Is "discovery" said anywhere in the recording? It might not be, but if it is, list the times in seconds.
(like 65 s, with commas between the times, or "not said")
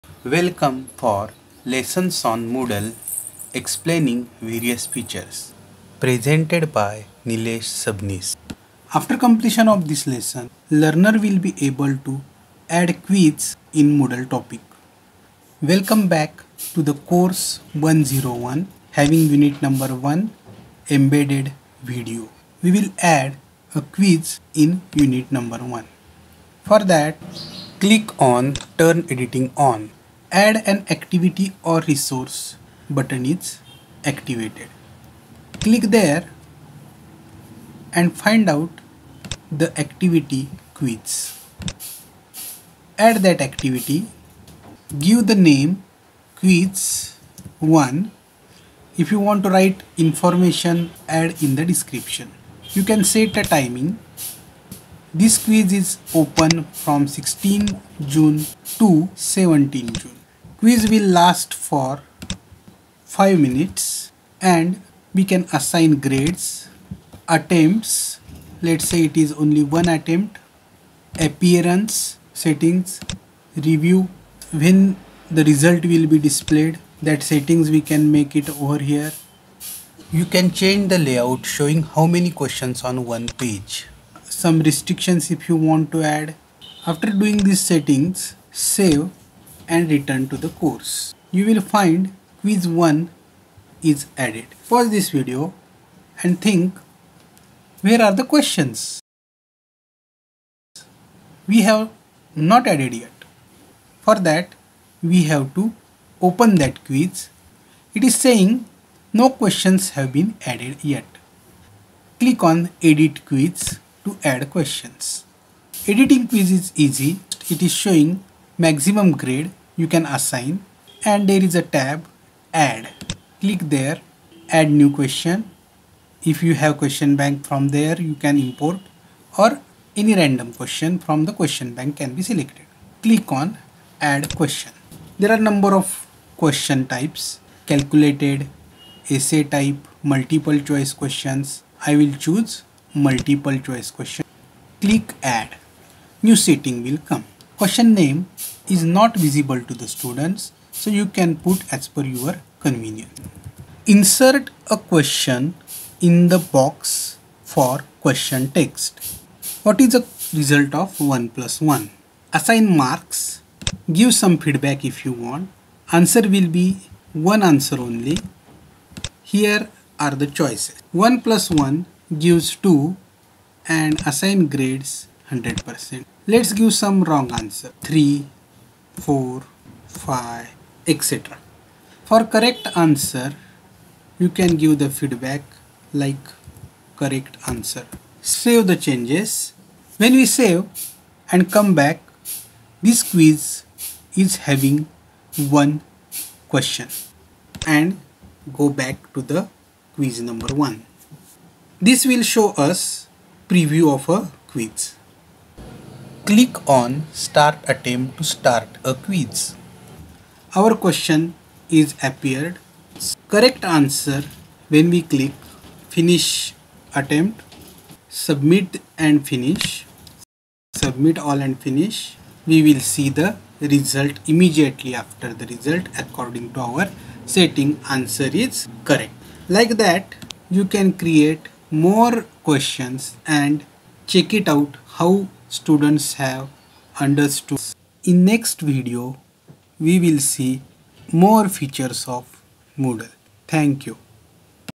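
not said.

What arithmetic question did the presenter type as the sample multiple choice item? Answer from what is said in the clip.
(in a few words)
What is the result of 1 plus 1?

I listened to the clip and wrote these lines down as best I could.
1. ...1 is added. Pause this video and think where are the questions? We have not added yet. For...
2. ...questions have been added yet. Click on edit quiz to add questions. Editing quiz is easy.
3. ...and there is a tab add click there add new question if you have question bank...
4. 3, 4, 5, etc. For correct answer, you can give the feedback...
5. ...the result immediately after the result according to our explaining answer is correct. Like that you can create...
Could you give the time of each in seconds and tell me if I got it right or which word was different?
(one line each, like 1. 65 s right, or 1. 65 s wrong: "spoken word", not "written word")
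1. 92 s right
2. 109 s right
3. 121 s right
4. 177 s right
5. 223 s wrong: "setting", not "explaining".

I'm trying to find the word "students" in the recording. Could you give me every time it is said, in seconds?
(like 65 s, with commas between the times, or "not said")
149 s, 235 s.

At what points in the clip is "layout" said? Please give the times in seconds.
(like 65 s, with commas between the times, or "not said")
80 s.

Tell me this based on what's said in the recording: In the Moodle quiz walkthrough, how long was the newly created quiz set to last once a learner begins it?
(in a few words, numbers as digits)
5 minutes.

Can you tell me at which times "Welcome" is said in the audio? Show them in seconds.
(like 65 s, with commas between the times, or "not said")
0 s, 15 s.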